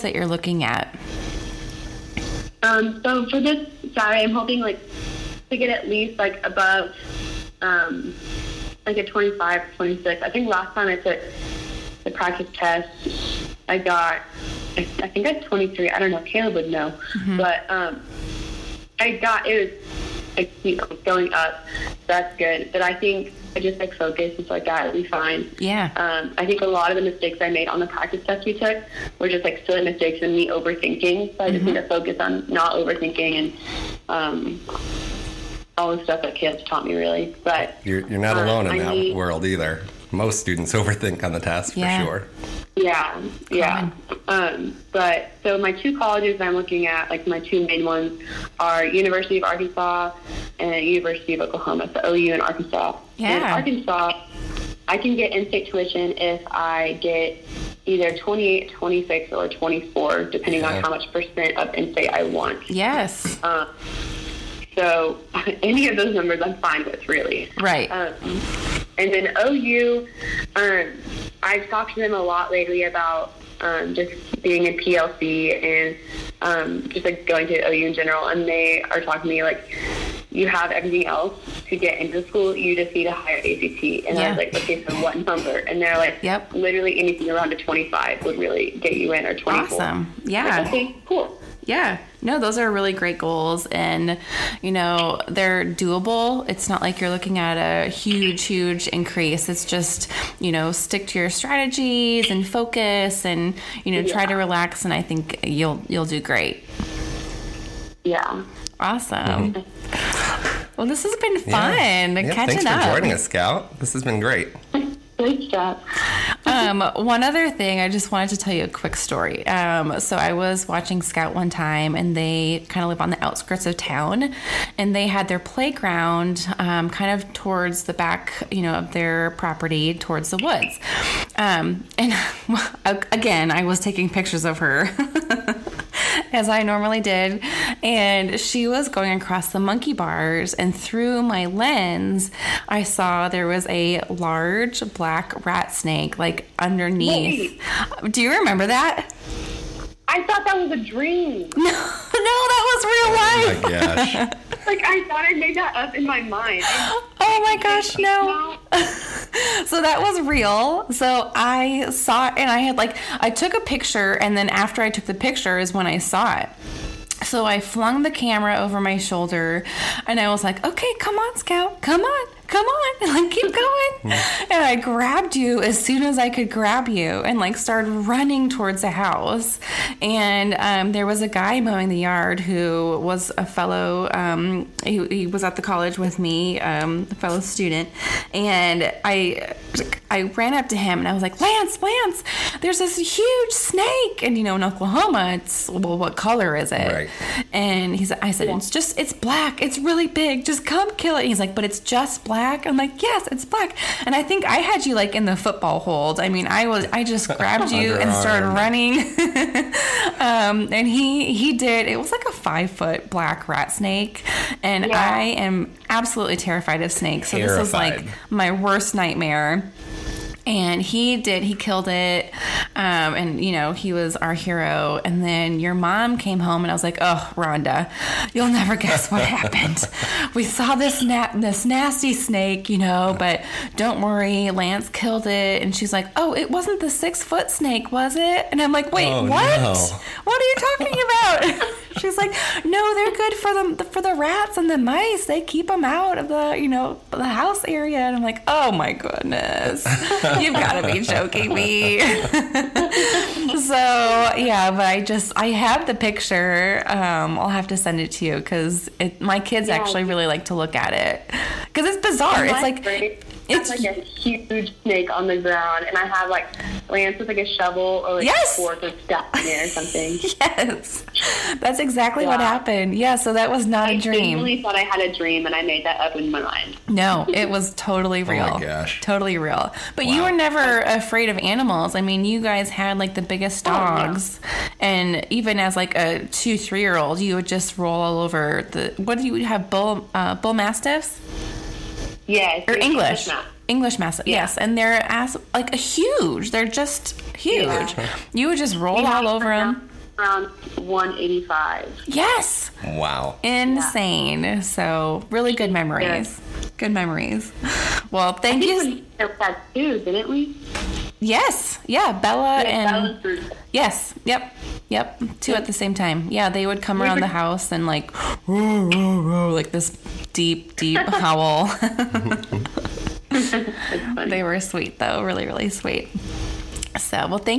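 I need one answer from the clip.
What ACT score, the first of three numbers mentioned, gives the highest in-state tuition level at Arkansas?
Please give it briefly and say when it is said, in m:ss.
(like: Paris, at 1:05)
28, at 0:58.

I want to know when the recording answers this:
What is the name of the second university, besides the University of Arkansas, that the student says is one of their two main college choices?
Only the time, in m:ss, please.
0:50.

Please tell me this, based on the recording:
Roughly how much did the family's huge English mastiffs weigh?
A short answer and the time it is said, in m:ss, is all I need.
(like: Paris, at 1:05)
185, at 5:00.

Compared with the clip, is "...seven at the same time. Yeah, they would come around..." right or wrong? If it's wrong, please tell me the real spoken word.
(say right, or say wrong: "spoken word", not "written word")
wrong: "two", not "seven".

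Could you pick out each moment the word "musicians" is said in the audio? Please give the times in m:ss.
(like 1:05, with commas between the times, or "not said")
not said.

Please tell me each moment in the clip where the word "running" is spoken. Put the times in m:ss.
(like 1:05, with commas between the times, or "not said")
2:57, 3:28.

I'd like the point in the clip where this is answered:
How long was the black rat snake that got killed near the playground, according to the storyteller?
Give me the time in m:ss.
3:32.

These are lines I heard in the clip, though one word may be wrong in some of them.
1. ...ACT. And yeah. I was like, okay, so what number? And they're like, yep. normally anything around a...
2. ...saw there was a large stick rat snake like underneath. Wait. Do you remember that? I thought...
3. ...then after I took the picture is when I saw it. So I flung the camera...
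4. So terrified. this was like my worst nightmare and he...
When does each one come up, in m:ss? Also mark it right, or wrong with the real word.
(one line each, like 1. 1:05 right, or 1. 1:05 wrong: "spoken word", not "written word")
1. 1:23 wrong: "literally", not "normally"
2. 2:22 wrong: "black", not "stick"
3. 2:44 right
4. 3:37 right.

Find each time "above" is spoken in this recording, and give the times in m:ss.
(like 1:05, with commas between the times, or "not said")
0:06.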